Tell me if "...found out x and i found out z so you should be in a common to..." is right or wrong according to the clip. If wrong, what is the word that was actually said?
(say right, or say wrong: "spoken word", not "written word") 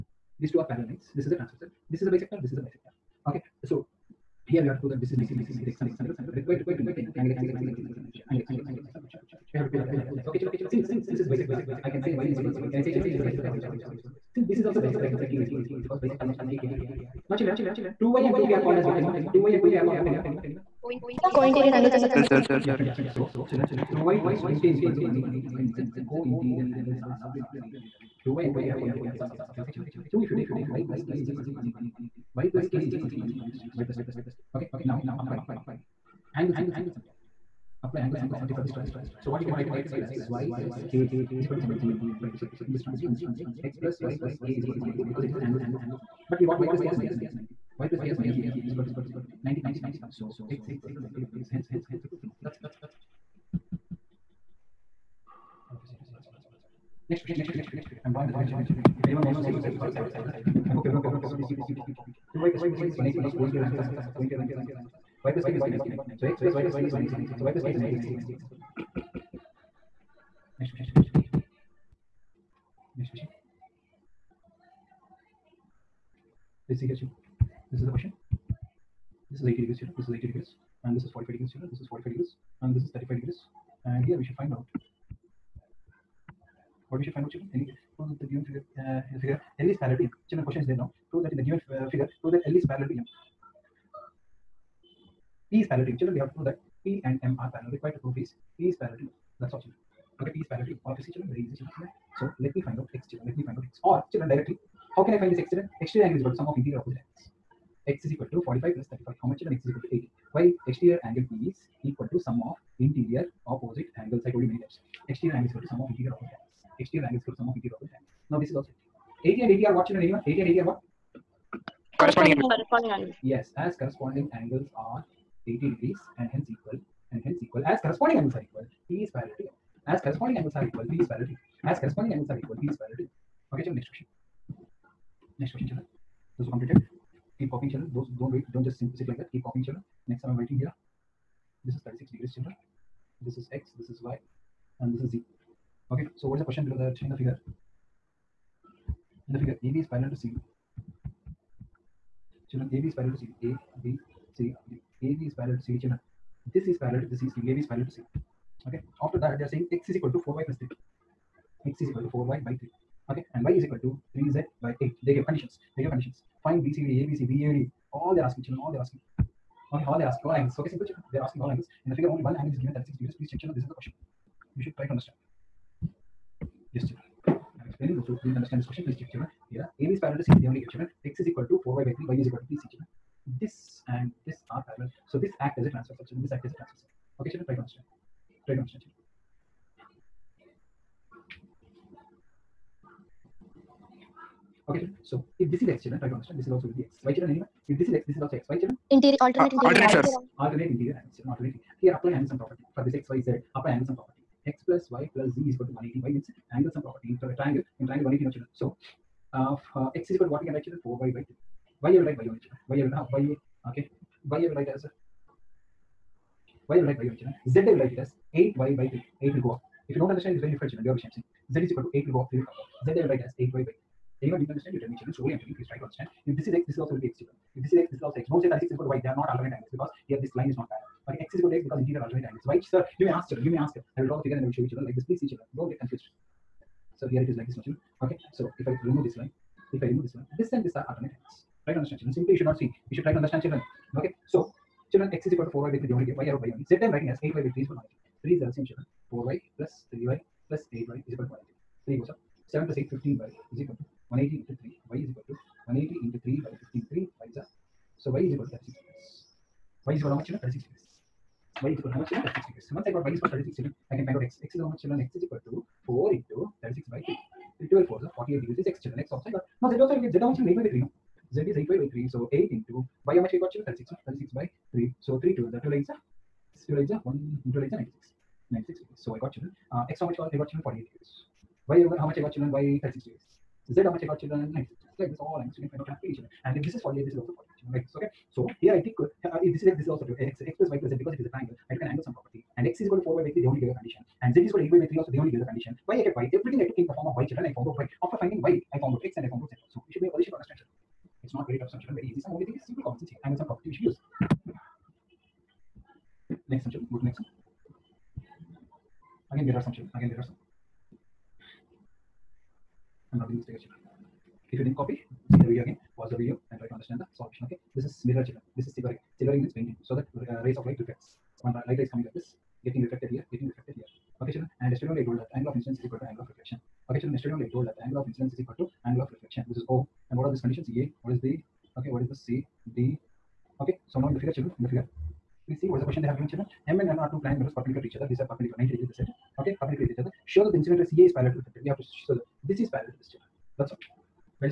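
wrong: "position", not "common".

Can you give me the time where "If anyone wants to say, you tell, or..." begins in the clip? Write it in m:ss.
0:58.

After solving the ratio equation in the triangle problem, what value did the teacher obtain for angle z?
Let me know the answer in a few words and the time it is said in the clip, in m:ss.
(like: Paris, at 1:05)
96 degrees, at 4:38.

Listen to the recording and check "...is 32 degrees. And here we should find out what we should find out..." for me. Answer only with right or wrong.
wrong.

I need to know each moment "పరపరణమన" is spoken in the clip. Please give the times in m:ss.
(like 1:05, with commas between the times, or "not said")
not said.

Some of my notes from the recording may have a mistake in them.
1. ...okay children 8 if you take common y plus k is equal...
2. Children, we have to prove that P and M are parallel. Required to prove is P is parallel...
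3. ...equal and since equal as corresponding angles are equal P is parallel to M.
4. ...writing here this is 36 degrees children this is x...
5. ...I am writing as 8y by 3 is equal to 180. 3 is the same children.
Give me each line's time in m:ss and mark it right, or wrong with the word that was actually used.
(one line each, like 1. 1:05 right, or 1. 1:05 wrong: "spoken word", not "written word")
1. 0:29 wrong: "2", not "8"
2. 1:35 right
3. 2:06 wrong: "hence", not "since"
4. 2:20 right
5. 4:06 right.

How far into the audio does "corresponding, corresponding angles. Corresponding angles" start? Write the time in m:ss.
2:02.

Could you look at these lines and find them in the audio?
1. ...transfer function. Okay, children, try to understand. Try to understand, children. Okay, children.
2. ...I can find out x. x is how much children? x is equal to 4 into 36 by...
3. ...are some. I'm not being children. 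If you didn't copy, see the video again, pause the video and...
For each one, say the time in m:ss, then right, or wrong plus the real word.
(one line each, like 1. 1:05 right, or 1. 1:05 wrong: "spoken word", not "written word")
1. 3:06 right
2. 4:23 right
3. 5:10 wrong: "mistaken", not "children".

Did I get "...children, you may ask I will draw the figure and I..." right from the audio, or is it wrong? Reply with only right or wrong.
right.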